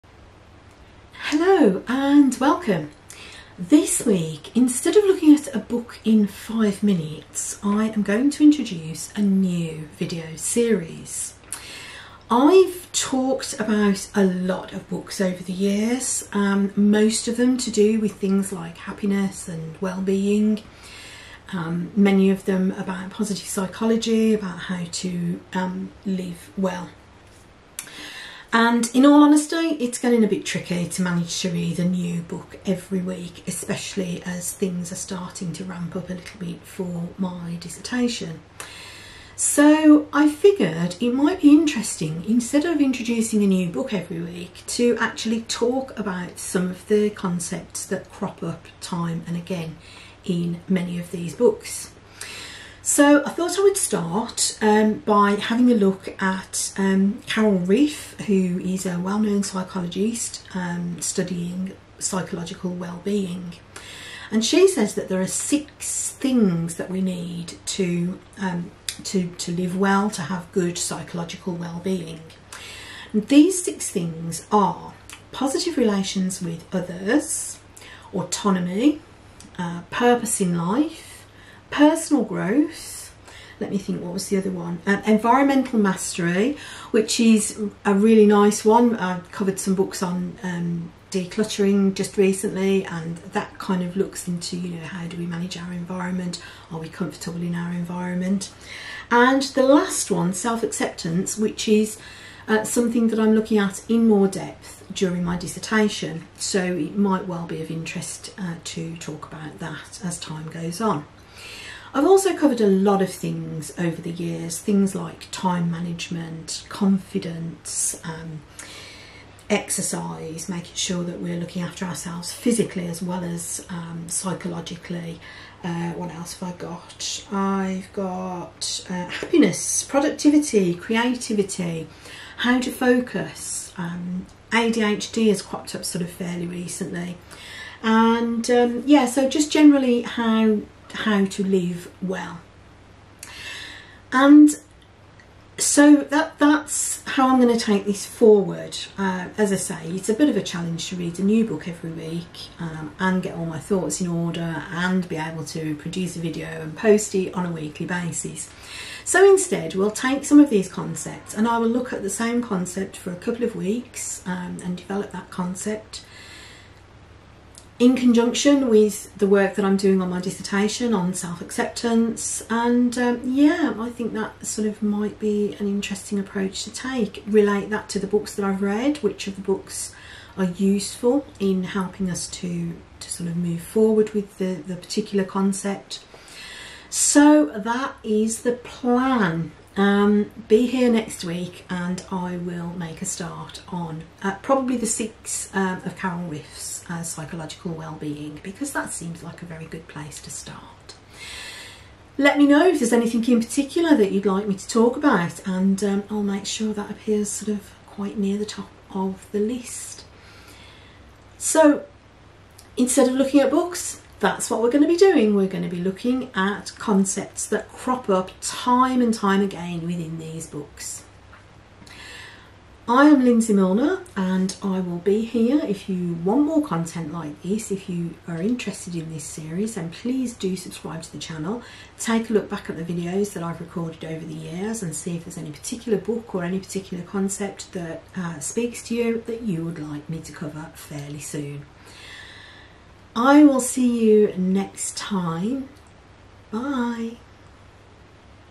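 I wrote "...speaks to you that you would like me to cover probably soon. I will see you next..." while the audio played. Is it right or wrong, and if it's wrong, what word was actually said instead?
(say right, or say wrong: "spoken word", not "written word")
wrong: "fairly", not "probably".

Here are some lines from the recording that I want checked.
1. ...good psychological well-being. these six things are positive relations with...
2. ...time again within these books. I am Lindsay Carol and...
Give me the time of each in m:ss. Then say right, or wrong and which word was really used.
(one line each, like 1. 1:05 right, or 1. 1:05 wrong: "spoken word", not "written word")
1. 1:10 right
2. 3:39 wrong: "Milner", not "Carol".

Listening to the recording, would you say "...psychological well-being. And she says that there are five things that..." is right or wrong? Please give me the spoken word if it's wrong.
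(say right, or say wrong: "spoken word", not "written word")
wrong: "six", not "five".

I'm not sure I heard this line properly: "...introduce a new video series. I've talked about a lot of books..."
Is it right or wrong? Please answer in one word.
right.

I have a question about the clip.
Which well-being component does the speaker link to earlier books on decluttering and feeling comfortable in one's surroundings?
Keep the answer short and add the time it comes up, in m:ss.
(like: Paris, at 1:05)
Environmental mastery, at 1:25.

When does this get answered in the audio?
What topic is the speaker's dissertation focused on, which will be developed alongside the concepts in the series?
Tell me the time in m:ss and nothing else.
2:51.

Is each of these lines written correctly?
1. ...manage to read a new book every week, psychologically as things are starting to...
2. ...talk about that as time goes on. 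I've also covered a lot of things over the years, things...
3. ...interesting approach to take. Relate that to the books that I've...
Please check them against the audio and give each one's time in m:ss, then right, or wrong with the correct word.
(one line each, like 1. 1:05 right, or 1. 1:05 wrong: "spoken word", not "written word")
1. 0:31 wrong: "especially", not "psychologically"
2. 1:48 right
3. 2:55 right.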